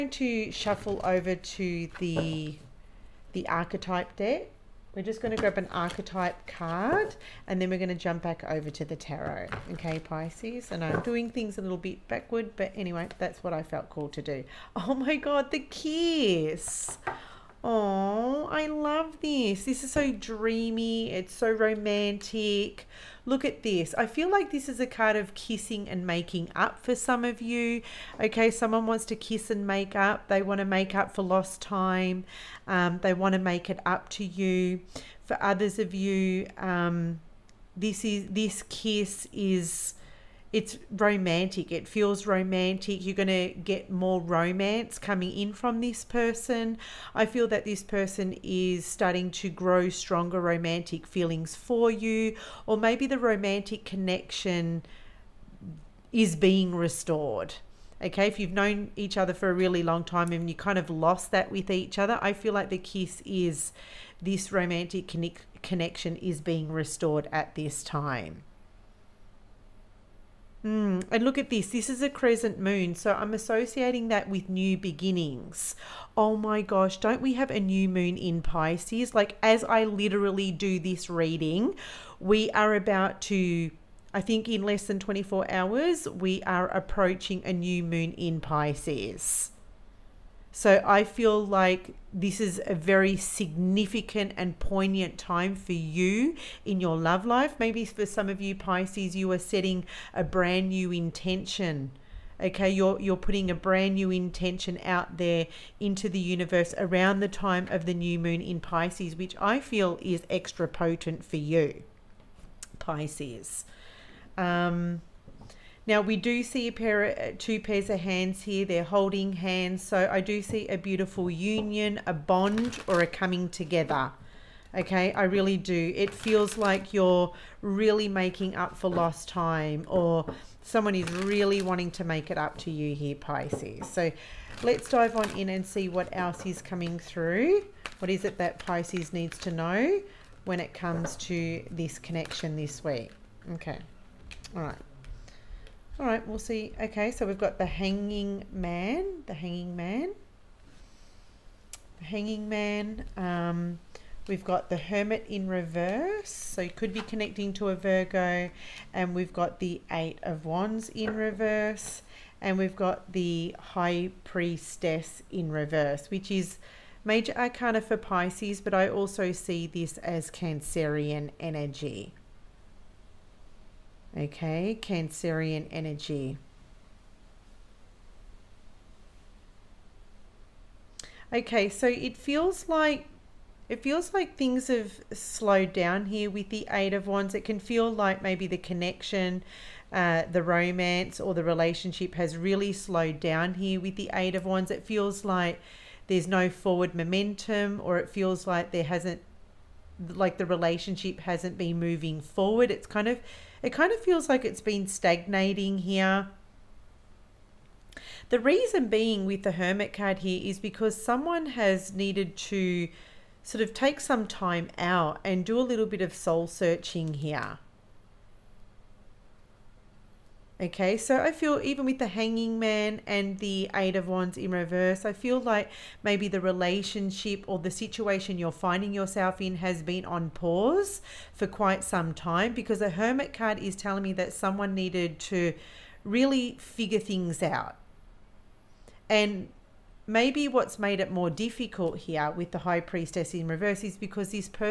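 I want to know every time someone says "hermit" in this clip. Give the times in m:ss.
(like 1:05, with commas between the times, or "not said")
2:34, 3:29, 3:52.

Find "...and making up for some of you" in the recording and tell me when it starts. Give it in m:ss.
0:25.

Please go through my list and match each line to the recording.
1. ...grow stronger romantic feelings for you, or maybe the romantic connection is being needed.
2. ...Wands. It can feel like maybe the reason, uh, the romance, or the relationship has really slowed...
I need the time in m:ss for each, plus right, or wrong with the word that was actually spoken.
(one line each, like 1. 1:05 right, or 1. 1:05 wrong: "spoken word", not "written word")
1. 0:49 wrong: "restored", not "needed"
2. 3:07 wrong: "connection", not "reason".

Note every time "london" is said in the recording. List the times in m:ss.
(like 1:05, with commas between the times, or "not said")
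not said.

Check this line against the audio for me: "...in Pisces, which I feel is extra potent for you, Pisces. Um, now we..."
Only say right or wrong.
right.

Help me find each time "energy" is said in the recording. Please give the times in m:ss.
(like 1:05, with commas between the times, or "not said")
2:51, 2:55.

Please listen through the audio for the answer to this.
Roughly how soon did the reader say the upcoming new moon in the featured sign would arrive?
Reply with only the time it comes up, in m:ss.
1:24.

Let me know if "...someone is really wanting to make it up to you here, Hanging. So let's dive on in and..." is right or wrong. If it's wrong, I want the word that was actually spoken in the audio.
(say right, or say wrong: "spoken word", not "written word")
wrong: "Pisces", not "Hanging".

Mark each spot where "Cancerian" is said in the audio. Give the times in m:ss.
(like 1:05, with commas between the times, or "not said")
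2:50, 2:54.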